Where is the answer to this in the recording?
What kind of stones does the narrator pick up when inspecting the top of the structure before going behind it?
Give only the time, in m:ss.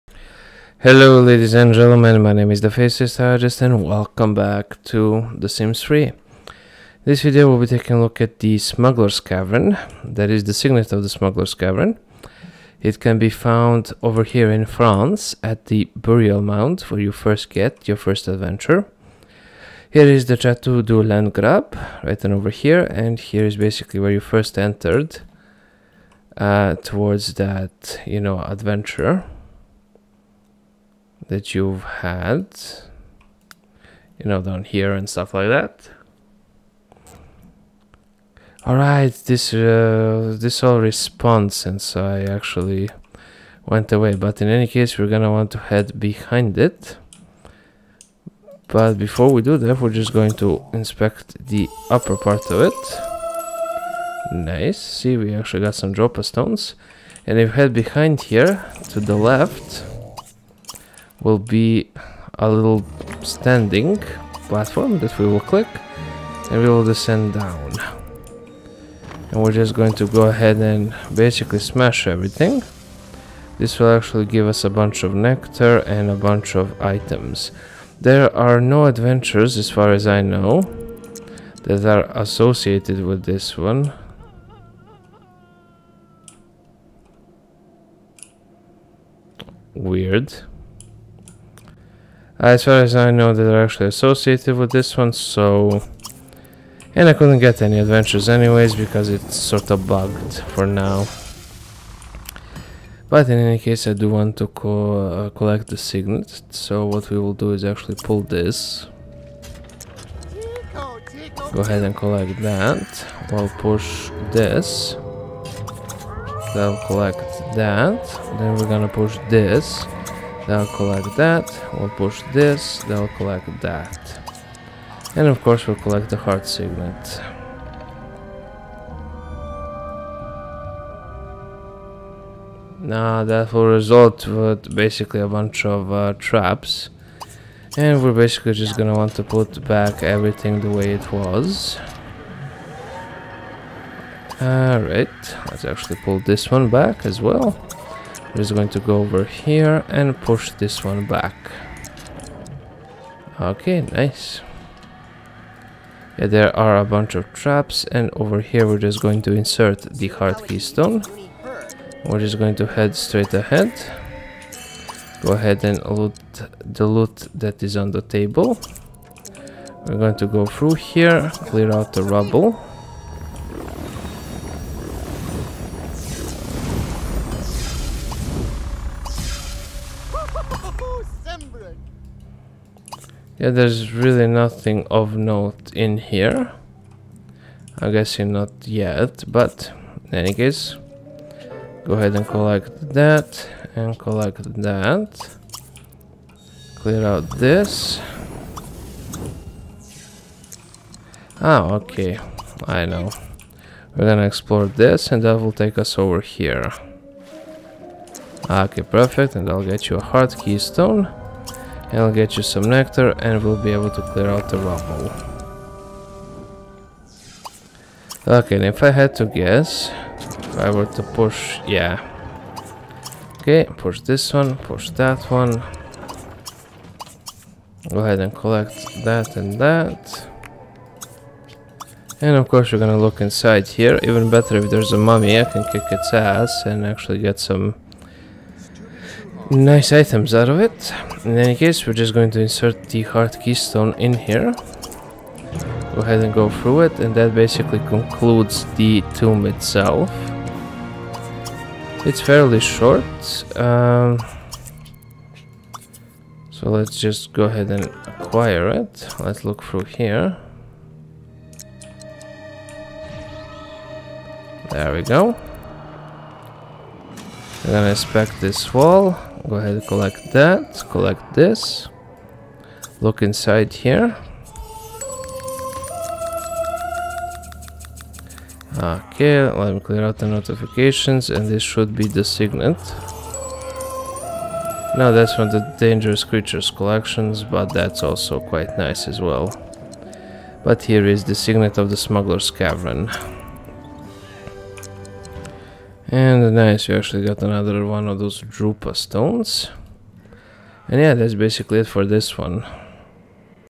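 0:55.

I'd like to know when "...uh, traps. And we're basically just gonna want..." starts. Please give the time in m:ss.
2:15.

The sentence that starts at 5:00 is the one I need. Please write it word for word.
And yeah, that's basically it for this one.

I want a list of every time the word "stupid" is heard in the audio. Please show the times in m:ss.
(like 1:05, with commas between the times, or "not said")
not said.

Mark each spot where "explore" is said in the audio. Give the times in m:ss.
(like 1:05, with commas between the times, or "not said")
3:24.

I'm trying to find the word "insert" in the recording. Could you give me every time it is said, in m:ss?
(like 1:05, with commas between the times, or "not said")
2:39, 4:02.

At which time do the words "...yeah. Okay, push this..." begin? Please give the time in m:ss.
3:41.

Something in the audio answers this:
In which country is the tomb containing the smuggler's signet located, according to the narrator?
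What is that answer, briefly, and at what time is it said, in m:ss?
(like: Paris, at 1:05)
France, at 0:14.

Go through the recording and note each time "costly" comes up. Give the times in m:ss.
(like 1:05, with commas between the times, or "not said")
not said.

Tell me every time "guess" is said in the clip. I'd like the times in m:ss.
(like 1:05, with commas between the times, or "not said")
3:07, 3:39.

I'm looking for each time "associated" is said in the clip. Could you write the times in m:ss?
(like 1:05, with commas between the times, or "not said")
1:22, 1:33.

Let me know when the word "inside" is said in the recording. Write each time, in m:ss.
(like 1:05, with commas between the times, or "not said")
3:53, 4:33.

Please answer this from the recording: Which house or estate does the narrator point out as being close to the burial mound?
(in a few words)
Chateau du Landgraab.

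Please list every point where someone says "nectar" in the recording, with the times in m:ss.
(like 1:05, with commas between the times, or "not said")
1:15, 3:32.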